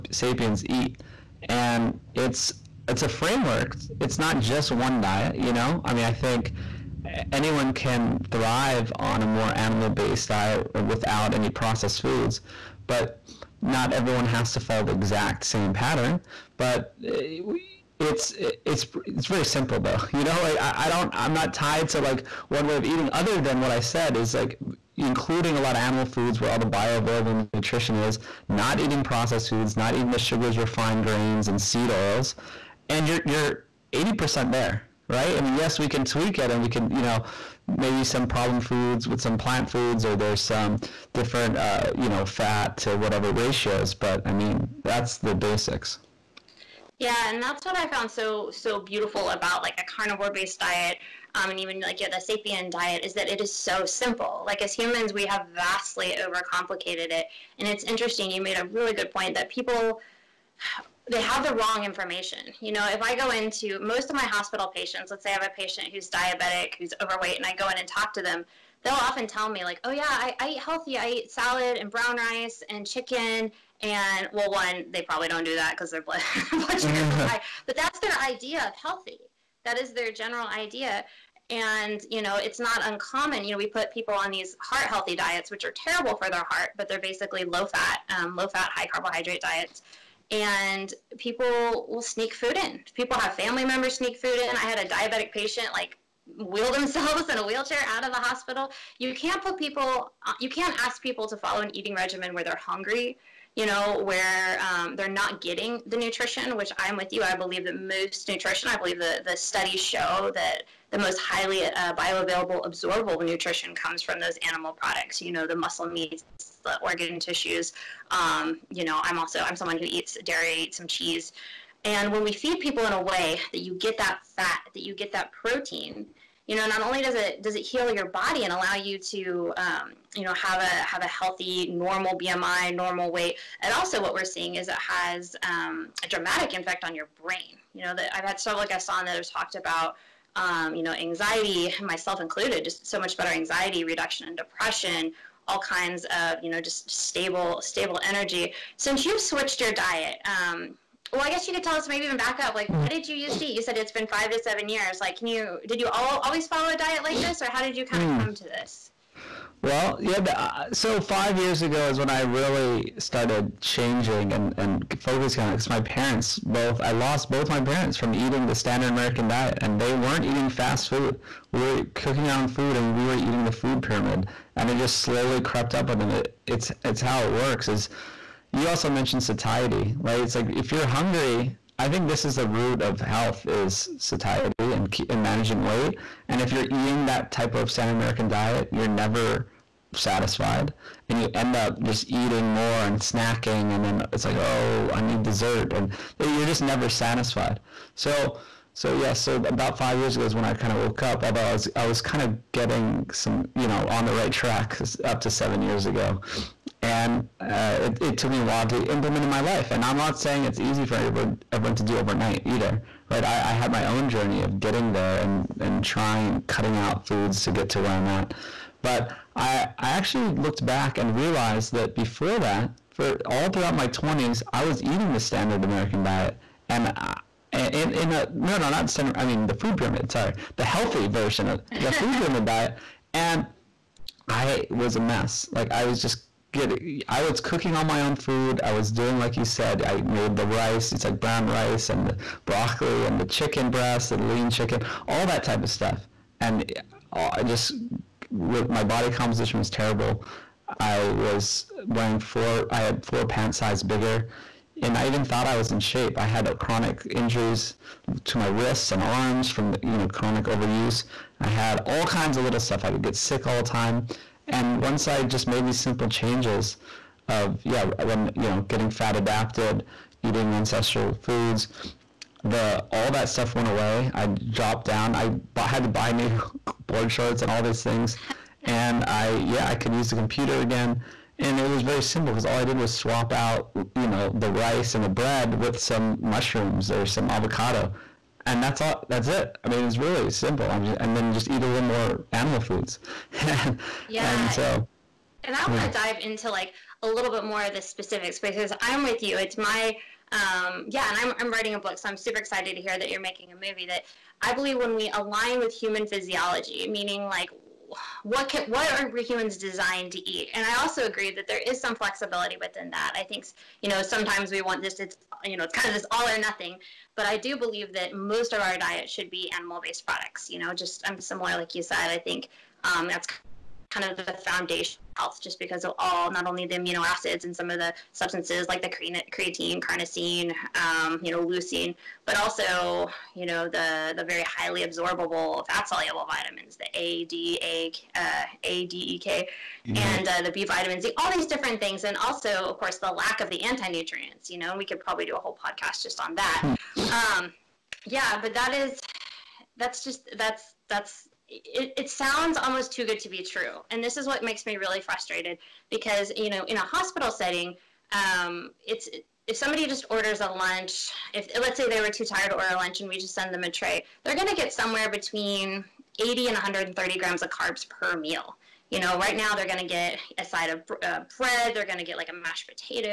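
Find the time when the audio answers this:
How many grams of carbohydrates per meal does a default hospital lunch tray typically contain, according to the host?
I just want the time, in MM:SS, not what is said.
06:06.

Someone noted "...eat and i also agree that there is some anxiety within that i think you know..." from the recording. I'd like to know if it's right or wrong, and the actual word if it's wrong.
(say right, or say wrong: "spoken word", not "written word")
wrong: "flexibility", not "anxiety".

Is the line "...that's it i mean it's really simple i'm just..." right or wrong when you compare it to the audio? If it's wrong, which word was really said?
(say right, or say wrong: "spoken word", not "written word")
right.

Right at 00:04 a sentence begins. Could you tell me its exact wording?
It's not just one diet, you know.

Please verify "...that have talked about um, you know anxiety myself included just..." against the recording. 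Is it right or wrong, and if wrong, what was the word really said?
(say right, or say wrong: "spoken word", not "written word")
right.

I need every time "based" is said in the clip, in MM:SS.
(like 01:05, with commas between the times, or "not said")
00:09, 00:50, 05:19.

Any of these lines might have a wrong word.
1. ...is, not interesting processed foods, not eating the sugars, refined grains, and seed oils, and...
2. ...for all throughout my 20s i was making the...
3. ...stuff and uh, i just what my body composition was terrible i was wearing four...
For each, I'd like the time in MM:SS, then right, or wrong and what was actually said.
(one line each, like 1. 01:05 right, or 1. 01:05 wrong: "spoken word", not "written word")
1. 00:27 wrong: "eating", not "interesting"
2. 03:42 wrong: "eating", not "making"
3. 04:05 right.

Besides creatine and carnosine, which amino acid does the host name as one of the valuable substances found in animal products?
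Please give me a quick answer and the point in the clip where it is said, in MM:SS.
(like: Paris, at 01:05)
leucine, at 05:31.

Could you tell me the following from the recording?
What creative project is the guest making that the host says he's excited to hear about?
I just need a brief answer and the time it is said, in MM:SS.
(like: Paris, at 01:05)
a movie, at 05:03.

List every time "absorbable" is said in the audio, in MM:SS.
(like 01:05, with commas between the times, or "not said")
01:52, 05:34.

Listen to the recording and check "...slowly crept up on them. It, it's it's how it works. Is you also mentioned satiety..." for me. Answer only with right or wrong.
right.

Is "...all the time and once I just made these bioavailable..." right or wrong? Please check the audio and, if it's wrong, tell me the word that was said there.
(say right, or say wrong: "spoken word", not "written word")
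wrong: "simple", not "bioavailable".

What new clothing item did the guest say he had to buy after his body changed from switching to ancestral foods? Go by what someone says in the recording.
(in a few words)
board shorts.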